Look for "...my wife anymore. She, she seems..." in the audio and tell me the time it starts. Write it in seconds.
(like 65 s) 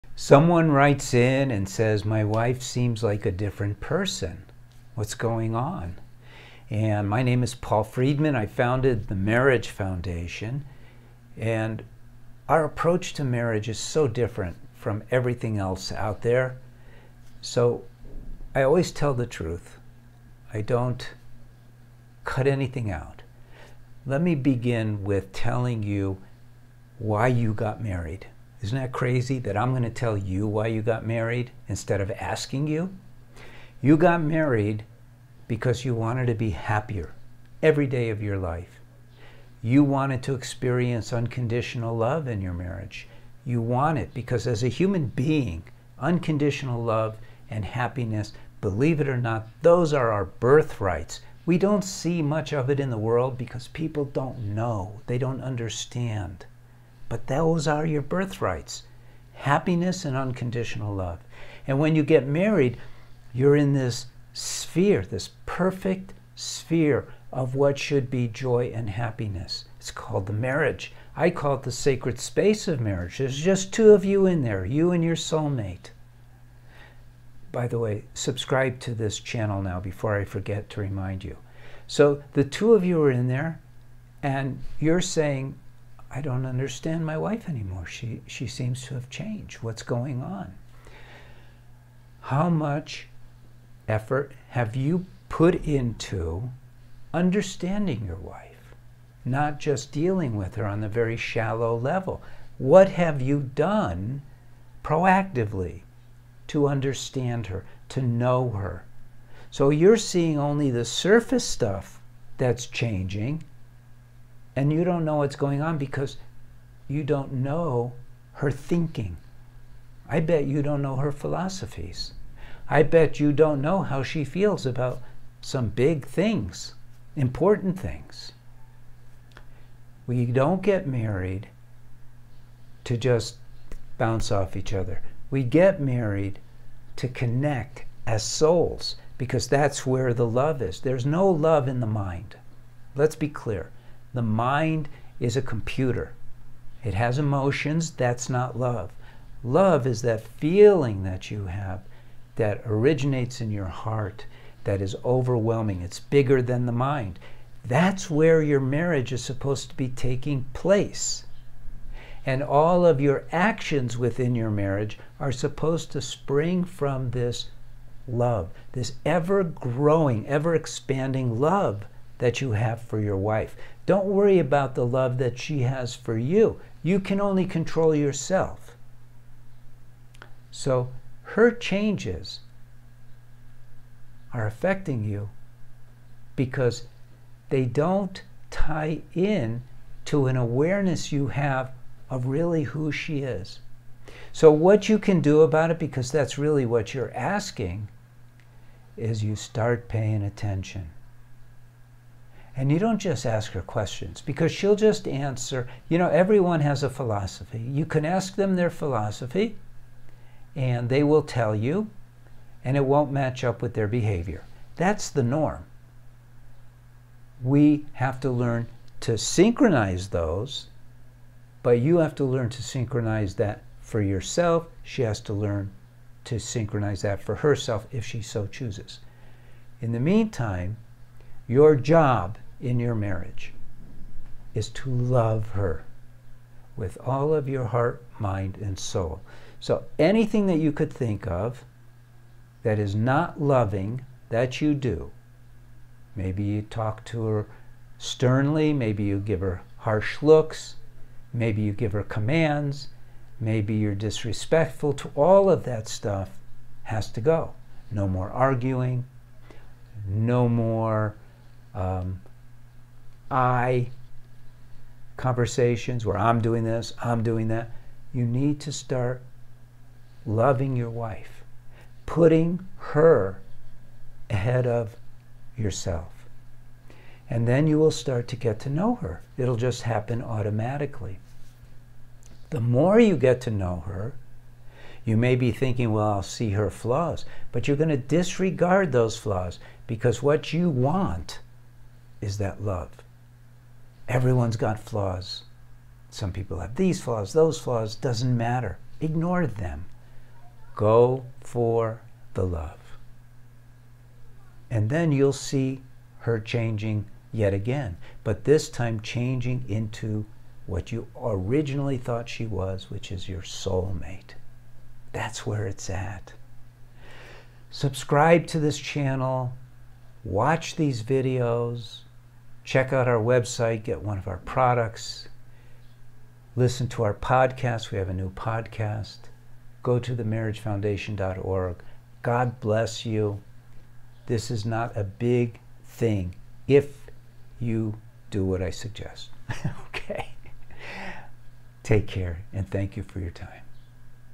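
87 s.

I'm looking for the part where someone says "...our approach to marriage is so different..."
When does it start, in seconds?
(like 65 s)
12 s.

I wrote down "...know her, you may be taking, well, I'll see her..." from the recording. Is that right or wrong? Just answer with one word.
wrong.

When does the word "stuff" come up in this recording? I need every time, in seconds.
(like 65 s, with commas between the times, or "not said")
111 s, 255 s.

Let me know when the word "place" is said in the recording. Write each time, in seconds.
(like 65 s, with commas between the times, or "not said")
160 s.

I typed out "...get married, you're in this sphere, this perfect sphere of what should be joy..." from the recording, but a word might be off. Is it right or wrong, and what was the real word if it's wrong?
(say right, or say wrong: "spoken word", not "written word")
right.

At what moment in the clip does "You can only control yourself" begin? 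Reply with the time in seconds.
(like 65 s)
176 s.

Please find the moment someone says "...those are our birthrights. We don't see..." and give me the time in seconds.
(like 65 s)
49 s.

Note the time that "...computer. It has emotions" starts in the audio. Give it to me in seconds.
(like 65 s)
145 s.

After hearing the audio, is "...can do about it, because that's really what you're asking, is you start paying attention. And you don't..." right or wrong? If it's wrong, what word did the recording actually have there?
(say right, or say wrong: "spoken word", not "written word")
right.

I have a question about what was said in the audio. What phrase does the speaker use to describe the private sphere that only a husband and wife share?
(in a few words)
sacred space of marriage.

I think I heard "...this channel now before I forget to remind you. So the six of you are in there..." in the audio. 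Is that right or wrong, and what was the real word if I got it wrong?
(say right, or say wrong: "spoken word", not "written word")
wrong: "two", not "six".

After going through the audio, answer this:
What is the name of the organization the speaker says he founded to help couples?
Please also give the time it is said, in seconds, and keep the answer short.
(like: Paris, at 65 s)
Marriage Foundation, at 9 s.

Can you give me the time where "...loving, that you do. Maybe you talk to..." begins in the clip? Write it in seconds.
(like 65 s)
243 s.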